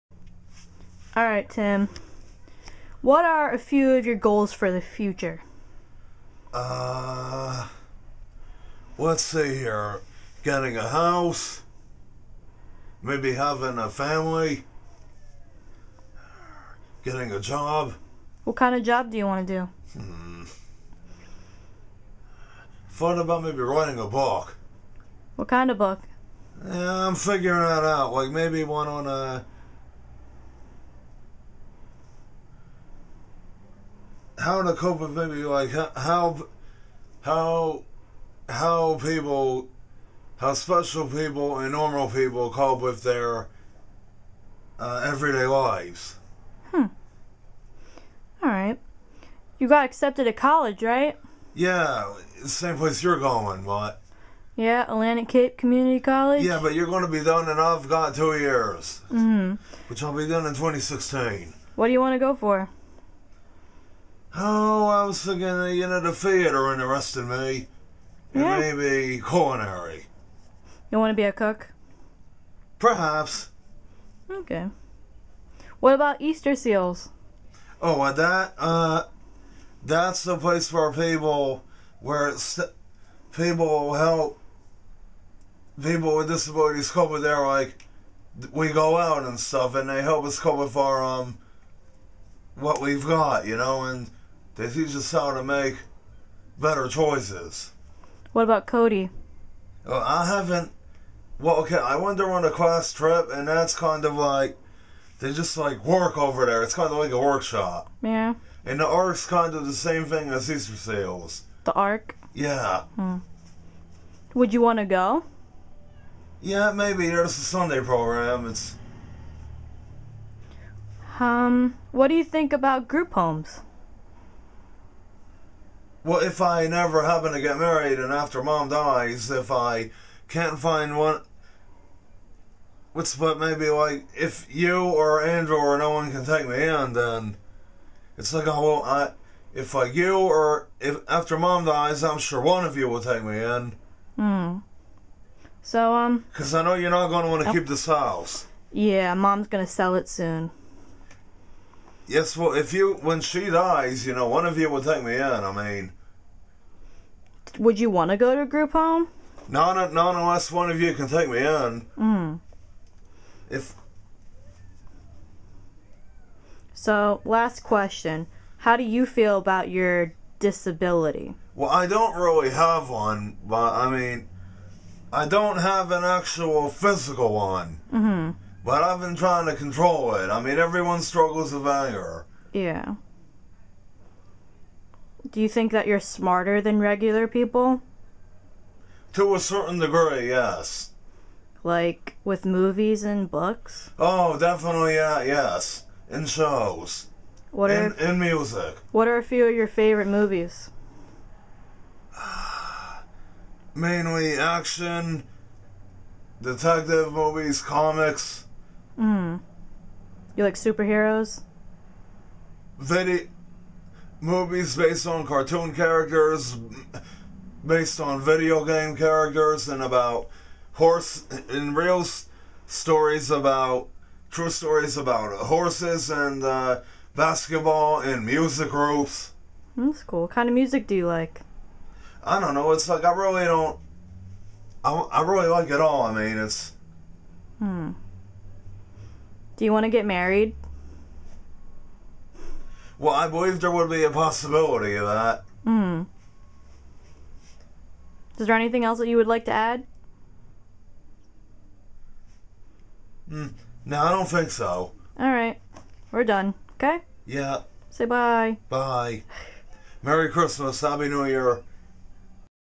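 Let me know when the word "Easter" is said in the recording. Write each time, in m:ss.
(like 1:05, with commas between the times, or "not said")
1:16, 1:50.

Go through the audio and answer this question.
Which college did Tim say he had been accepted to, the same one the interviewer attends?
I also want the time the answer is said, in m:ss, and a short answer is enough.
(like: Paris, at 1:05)
Atlantic Cape Community College, at 0:54.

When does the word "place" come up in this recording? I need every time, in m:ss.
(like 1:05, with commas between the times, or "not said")
0:52, 1:20.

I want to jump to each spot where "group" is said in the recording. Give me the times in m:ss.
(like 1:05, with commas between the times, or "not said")
2:02, 2:38, 3:48.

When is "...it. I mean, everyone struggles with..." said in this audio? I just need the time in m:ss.
3:00.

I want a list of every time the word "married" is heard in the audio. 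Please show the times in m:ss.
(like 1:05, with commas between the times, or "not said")
2:07, 4:00.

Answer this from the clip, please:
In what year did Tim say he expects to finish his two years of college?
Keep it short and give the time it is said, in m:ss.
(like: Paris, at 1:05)
2016, at 1:00.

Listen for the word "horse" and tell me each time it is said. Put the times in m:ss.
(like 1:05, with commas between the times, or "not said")
3:40, 3:45.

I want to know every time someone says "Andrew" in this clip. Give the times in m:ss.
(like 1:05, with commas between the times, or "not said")
2:15.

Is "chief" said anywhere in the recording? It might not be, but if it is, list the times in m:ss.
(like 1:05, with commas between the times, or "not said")
not said.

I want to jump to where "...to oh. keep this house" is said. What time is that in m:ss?
2:27.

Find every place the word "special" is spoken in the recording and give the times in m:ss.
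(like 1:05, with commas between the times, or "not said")
0:40.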